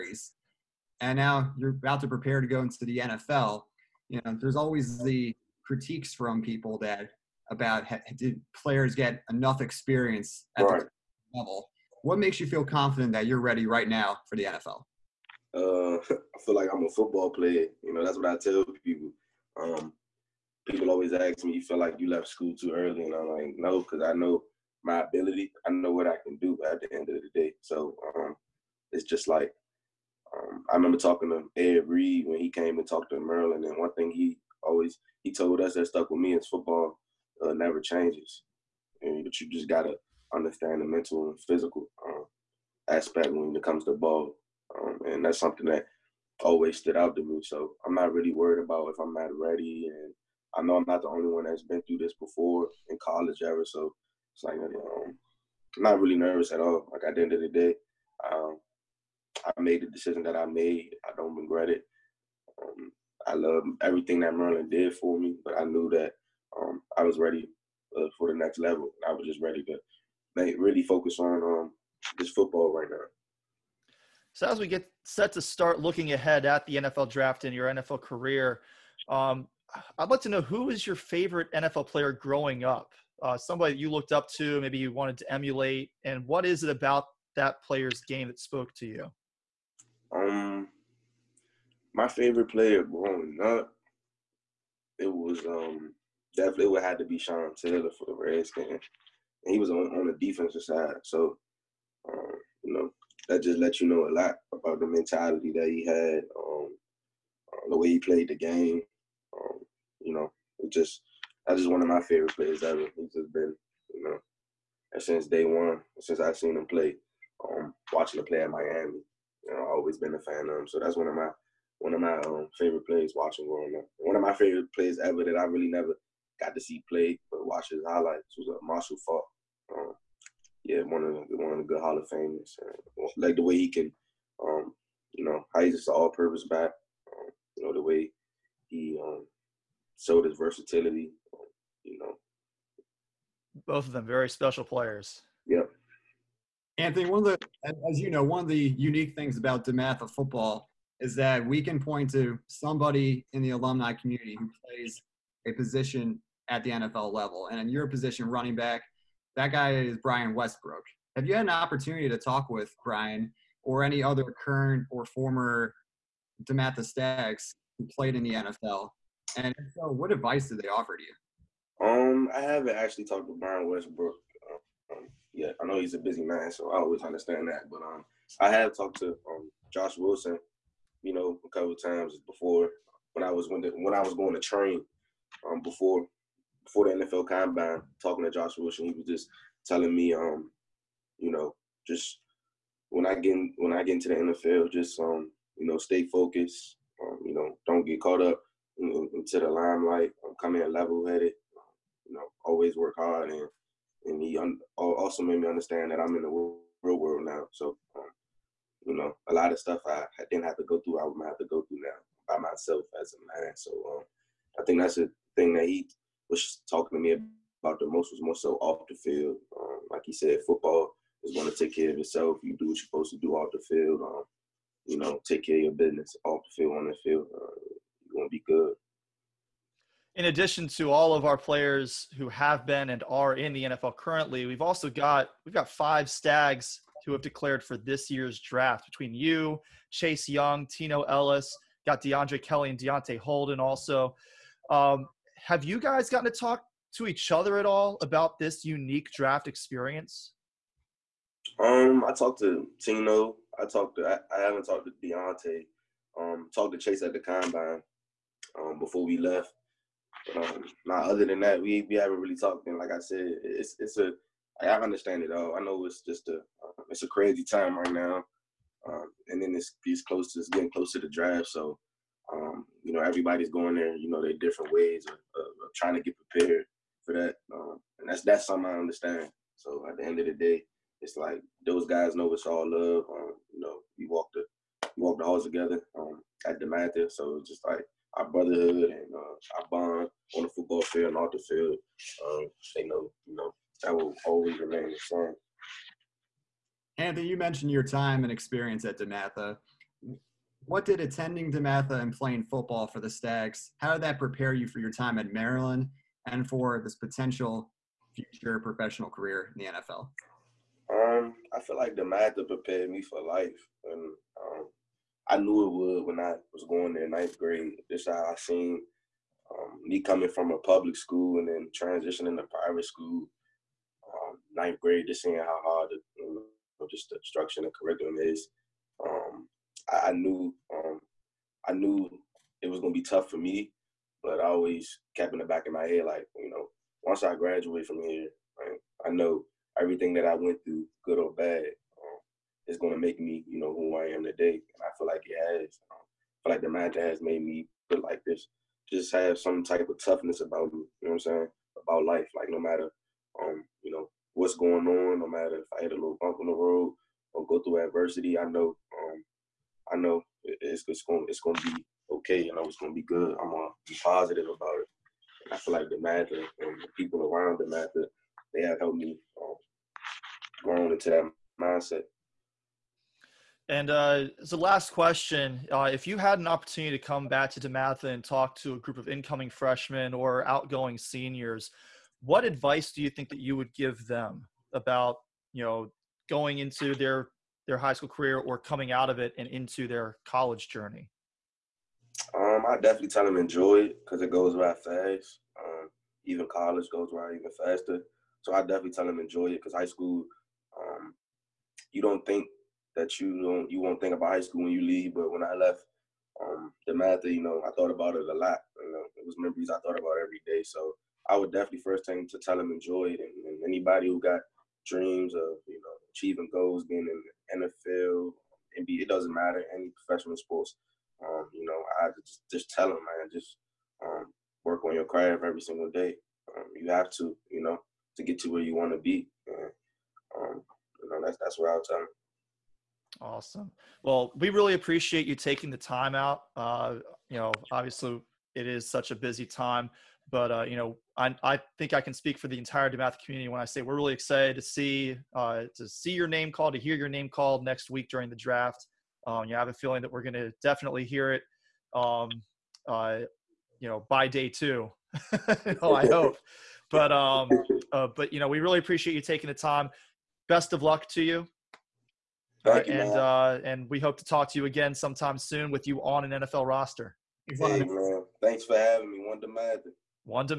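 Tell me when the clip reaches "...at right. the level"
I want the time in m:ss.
0:10.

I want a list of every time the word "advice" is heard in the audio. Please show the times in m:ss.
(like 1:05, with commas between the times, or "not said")
2:50, 6:22.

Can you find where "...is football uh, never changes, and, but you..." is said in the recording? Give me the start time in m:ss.
0:36.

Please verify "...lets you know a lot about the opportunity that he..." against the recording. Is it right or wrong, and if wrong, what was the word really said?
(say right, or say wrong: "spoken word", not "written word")
wrong: "mentality", not "opportunity".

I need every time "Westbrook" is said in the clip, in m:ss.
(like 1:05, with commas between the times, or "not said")
2:40, 2:53.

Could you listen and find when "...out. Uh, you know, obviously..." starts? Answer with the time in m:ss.
7:16.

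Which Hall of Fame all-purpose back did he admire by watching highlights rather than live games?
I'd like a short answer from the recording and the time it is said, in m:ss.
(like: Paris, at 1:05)
Marshall Faulk, at 2:08.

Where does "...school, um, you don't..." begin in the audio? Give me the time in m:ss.
6:39.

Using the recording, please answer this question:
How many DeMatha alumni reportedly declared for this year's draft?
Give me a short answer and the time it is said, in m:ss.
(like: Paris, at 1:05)
5, at 3:55.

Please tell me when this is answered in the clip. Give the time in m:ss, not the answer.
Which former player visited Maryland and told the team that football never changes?
0:31.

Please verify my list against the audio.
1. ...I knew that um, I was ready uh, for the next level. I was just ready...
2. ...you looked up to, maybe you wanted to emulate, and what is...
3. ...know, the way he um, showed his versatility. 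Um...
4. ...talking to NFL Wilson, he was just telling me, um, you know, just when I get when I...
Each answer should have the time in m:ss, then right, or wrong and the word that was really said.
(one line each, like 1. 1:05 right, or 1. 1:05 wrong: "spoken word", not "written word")
1. 1:05 right
2. 1:23 right
3. 2:17 right
4. 3:08 wrong: "Josh", not "NFL".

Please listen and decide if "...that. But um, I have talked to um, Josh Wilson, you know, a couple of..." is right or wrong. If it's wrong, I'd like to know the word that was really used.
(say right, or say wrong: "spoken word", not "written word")
right.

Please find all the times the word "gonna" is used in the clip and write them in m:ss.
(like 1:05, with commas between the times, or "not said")
5:32, 6:03.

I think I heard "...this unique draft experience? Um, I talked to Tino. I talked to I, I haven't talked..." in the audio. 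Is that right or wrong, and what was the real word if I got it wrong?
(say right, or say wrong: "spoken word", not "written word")
right.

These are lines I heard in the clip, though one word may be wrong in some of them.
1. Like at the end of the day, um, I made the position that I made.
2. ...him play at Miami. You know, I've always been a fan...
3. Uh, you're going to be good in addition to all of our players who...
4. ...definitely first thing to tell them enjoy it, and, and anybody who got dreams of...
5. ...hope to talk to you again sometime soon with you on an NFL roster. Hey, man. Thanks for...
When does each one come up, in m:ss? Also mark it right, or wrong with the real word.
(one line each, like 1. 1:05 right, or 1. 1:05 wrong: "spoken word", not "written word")
1. 0:56 wrong: "decision", not "position"
2. 1:58 right
3. 3:47 right
4. 6:51 right
5. 7:43 right.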